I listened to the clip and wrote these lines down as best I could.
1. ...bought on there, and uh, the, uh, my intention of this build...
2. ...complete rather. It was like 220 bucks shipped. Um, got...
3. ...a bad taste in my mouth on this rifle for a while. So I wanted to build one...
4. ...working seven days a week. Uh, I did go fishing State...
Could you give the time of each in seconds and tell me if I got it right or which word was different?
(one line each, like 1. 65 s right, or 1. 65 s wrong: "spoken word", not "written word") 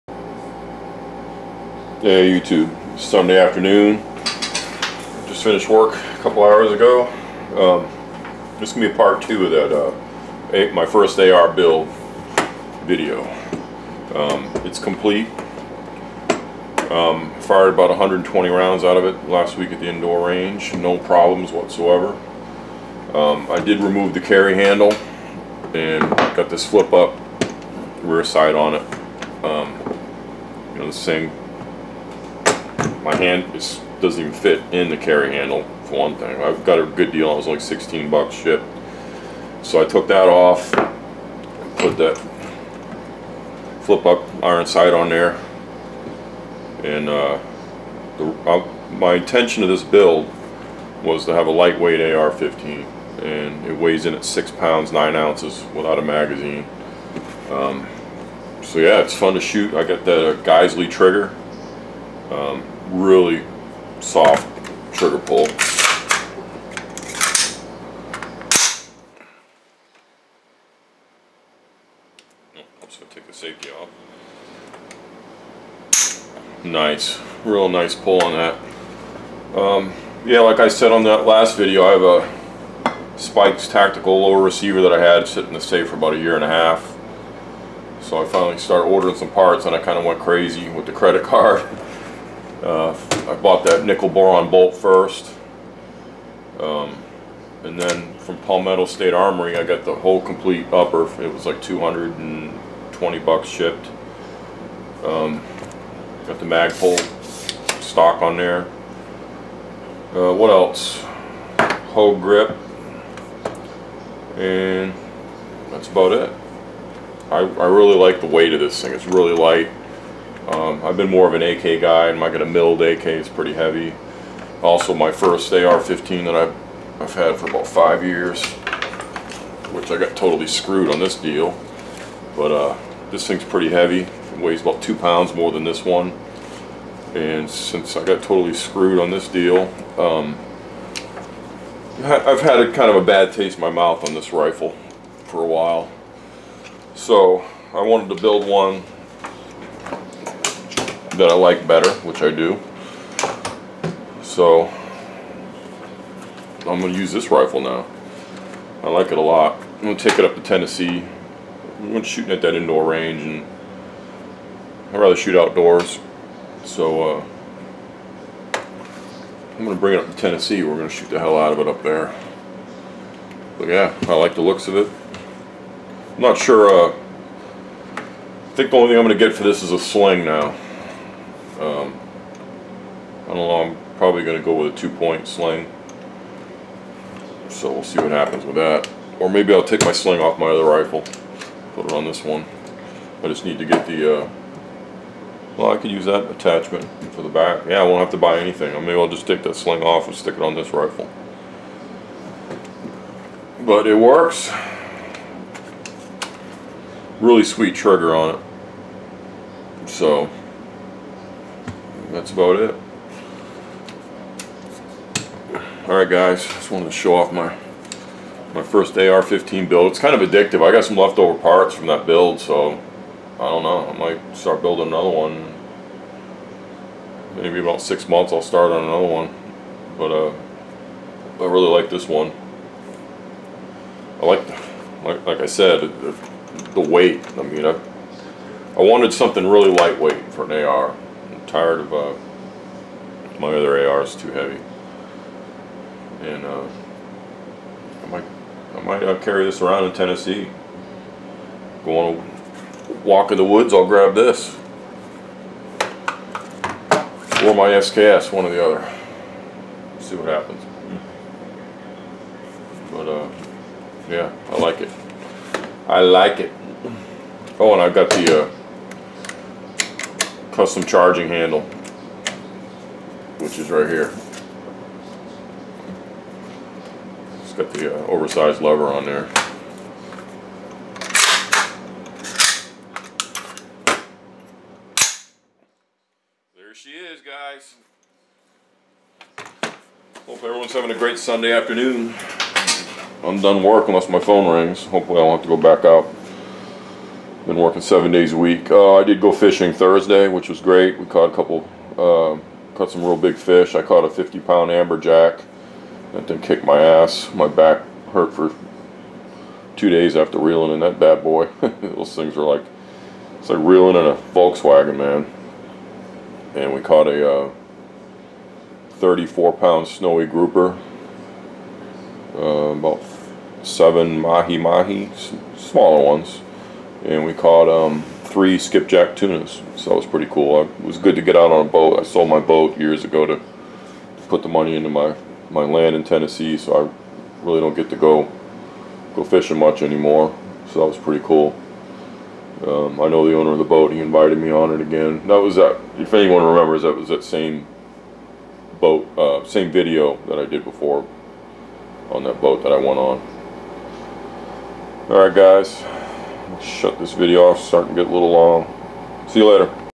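1. 44 s wrong: "sight", not "bought"
2. 100 s wrong: "upper", not "rather"
3. 143 s right
4. 297 s wrong: "Thursday", not "State".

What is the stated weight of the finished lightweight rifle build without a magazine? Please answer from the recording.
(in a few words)
6 pounds 9 ounces.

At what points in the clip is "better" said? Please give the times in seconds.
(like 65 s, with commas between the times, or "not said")
151 s.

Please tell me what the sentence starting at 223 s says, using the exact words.
I might start building another one.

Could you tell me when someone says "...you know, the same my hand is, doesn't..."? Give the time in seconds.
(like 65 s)
30 s.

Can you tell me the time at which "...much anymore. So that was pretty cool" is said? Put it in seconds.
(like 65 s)
339 s.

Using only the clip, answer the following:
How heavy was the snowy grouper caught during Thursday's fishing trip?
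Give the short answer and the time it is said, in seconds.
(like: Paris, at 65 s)
34 pounds, at 318 s.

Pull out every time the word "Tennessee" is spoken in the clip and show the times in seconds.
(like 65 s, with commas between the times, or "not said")
160 s, 170 s, 249 s, 336 s.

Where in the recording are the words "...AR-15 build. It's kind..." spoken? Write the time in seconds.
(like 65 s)
218 s.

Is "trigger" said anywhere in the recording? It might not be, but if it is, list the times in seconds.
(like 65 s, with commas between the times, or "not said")
60 s, 64 s, 207 s.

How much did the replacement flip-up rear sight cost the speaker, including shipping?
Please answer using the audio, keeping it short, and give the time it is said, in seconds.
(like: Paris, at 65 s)
$16, at 37 s.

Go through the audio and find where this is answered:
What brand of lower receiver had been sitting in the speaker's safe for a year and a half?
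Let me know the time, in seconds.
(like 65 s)
83 s.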